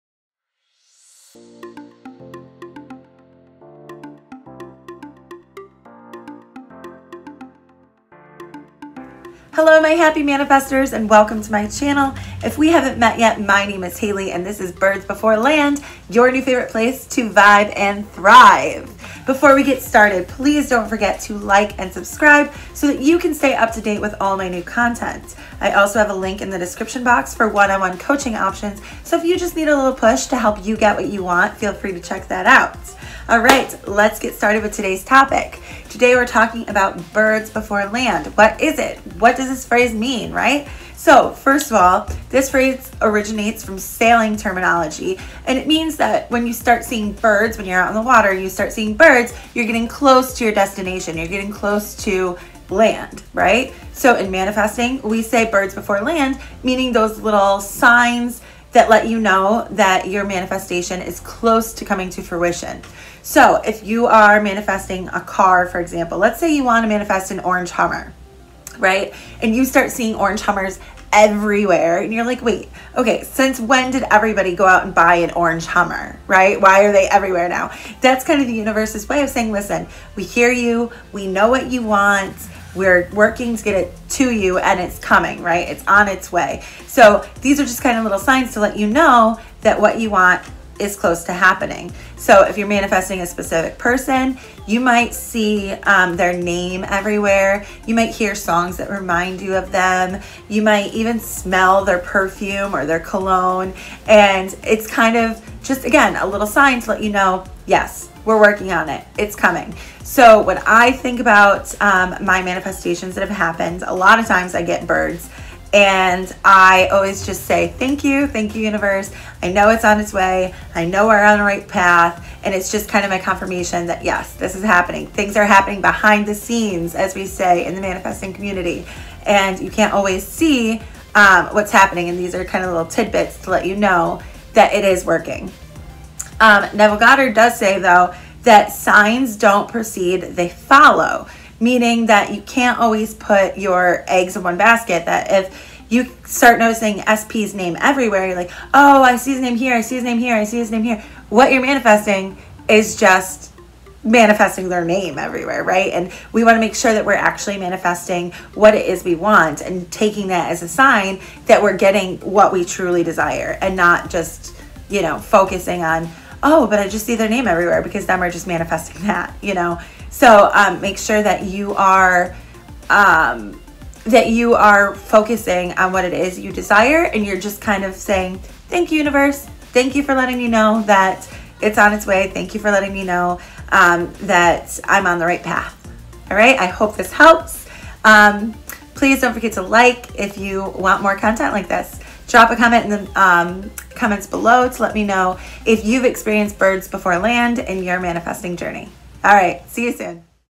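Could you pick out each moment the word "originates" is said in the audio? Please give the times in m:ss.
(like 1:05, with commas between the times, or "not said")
0:43.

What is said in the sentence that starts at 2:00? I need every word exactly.
I know we're on the right path.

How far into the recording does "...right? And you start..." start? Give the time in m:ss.
1:08.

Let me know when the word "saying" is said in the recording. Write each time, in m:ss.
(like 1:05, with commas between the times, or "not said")
1:19, 2:57.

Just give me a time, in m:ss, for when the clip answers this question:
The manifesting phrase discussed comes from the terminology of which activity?
0:43.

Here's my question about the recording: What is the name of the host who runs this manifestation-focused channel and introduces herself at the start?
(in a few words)
Haley.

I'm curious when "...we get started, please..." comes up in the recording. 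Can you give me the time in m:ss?
0:19.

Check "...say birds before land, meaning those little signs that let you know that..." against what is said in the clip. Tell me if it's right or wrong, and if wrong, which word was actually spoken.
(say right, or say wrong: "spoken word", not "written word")
right.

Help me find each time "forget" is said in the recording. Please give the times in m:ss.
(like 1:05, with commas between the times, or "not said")
0:20, 3:09.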